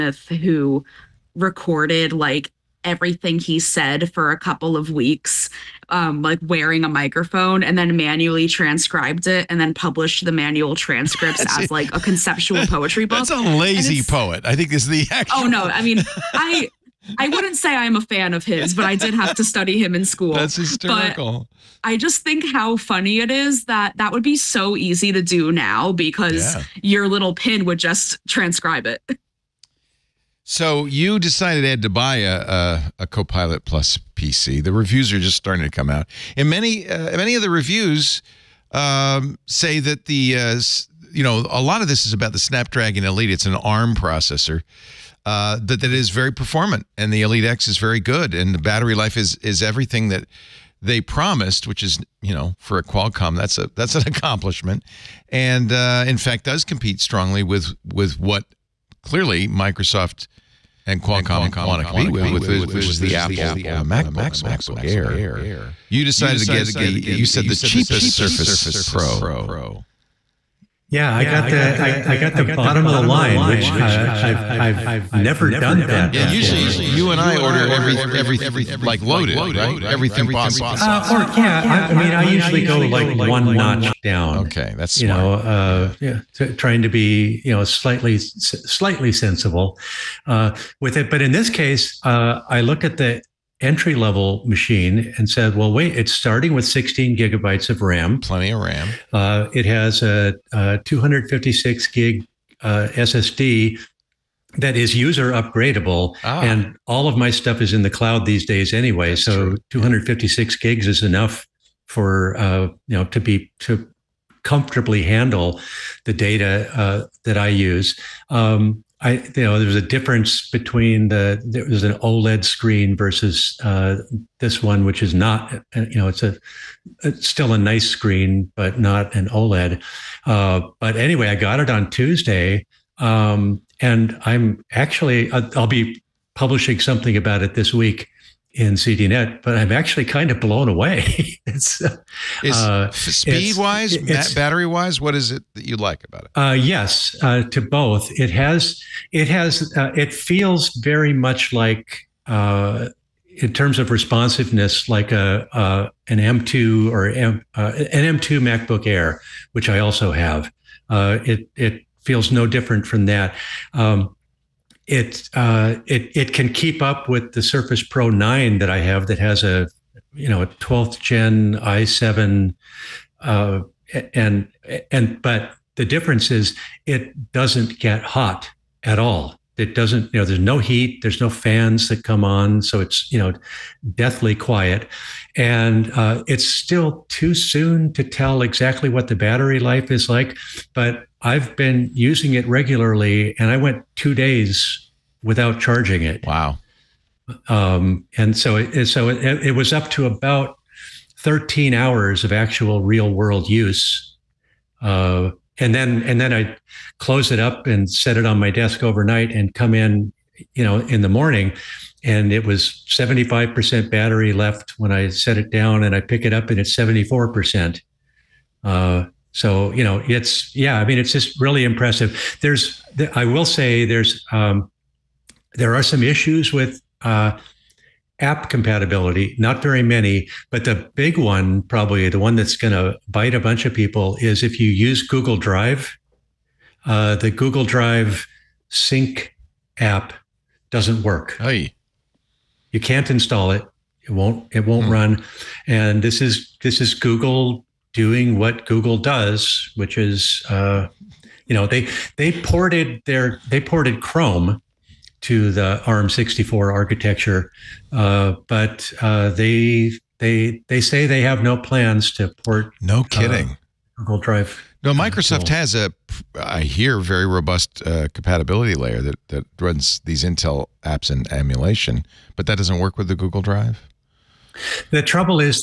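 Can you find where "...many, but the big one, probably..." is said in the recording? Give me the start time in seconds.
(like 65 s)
229 s.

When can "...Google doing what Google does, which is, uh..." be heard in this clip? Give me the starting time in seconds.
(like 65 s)
246 s.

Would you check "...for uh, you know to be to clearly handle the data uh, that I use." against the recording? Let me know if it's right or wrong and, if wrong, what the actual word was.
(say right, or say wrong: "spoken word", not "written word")
wrong: "comfortably", not "clearly".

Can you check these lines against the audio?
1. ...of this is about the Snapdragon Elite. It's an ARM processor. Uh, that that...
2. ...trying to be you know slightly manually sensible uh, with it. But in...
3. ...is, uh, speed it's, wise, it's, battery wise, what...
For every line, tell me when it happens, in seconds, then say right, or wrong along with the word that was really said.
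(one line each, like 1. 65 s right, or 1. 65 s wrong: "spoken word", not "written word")
1. 41 s right
2. 86 s wrong: "slightly", not "manually"
3. 142 s right.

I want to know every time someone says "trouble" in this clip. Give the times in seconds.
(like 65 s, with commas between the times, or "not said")
275 s.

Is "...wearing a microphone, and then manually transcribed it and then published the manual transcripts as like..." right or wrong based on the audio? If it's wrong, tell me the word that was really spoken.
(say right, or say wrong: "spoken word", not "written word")
right.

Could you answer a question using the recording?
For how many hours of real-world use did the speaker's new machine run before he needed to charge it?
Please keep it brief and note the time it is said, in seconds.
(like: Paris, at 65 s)
13 hours, at 201 s.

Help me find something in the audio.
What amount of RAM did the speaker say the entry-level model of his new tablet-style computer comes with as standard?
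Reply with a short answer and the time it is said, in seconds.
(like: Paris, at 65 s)
16 GB, at 96 s.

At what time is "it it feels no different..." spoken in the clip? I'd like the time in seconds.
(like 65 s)
160 s.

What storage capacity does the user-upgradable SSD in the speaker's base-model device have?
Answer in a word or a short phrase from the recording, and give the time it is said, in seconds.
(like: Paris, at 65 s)
256 GB, at 100 s.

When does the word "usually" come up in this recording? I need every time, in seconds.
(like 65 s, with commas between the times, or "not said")
76 s, 82 s.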